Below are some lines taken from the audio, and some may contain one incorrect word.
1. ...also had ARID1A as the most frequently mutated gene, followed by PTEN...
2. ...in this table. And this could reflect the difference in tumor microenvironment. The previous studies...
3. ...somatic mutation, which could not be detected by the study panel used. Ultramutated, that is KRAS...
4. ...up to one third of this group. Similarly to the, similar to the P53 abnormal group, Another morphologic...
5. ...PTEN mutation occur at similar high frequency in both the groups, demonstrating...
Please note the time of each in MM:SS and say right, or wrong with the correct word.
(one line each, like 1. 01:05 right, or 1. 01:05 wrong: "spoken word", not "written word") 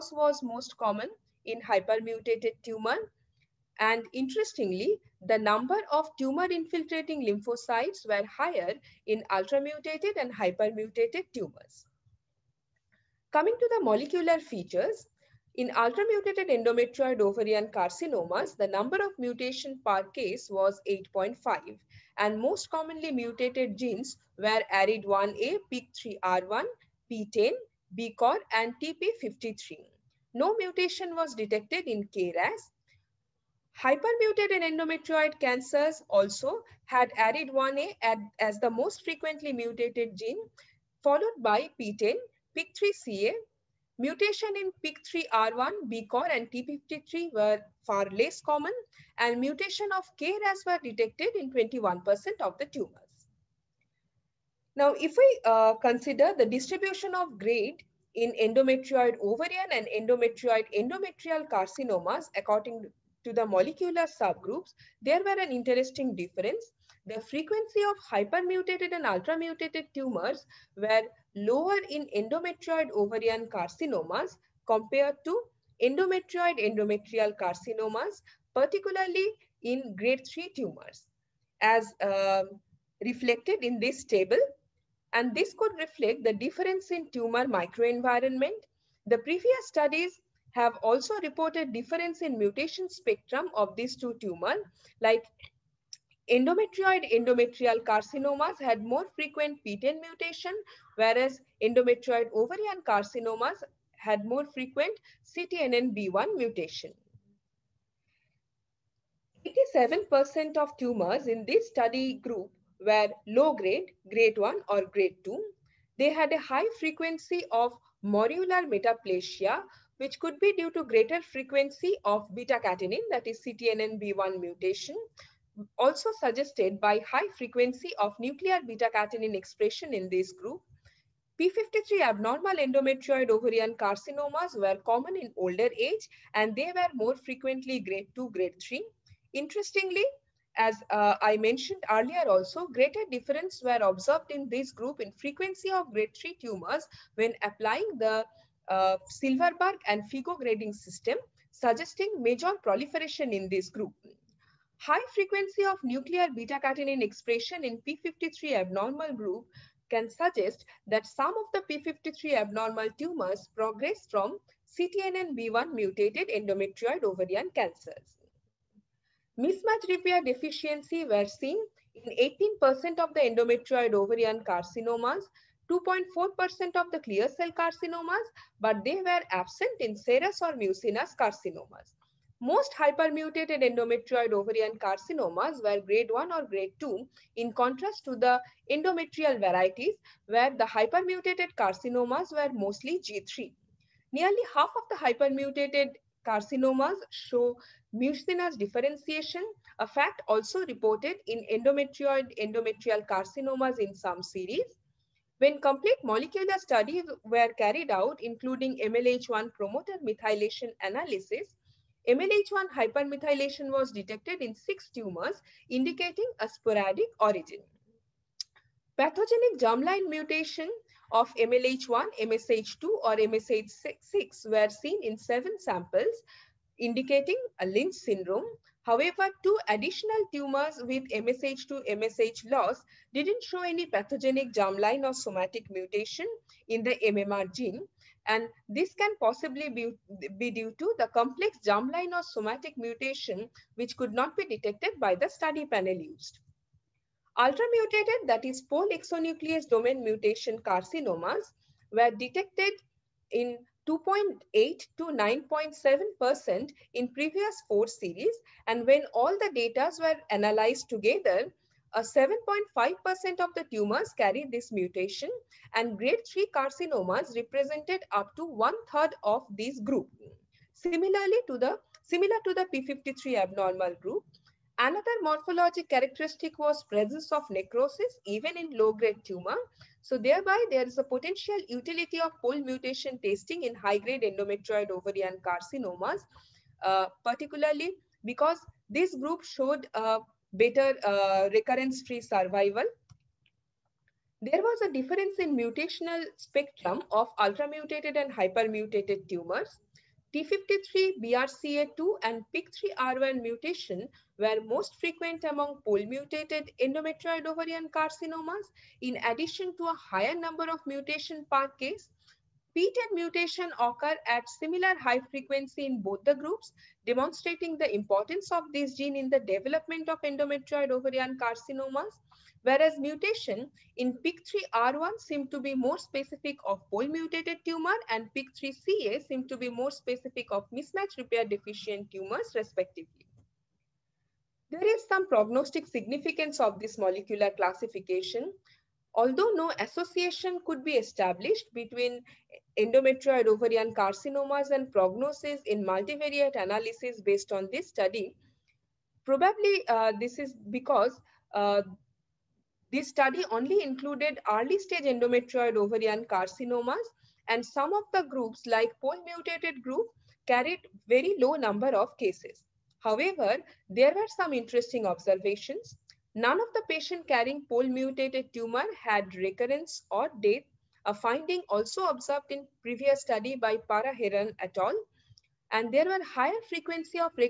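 1. 00:36 right
2. 01:23 right
3. 04:02 wrong: "POLE", not "KRAS"
4. 04:28 right
5. 05:12 right.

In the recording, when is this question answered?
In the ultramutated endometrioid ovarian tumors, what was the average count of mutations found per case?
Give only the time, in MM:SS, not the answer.
00:20.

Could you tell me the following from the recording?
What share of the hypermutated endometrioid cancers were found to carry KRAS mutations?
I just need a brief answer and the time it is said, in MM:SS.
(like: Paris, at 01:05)
21%, at 00:51.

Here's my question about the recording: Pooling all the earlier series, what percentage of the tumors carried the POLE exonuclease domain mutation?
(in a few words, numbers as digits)
7.5%.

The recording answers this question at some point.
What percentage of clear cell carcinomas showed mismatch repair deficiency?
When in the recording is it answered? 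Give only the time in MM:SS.
02:55.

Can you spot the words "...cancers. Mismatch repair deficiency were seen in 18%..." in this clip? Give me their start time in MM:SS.
02:47.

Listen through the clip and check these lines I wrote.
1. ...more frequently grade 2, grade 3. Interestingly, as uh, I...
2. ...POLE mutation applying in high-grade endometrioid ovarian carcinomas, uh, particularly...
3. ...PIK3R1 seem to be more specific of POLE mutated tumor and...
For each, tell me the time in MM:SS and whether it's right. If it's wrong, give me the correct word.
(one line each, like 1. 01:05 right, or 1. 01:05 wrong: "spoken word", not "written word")
1. 02:16 right
2. 04:42 wrong: "testing", not "applying"
3. 05:24 right.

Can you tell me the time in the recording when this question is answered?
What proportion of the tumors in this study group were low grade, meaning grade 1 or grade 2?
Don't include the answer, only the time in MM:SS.
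01:49.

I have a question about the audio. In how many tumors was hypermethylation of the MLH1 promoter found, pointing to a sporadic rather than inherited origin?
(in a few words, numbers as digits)
6.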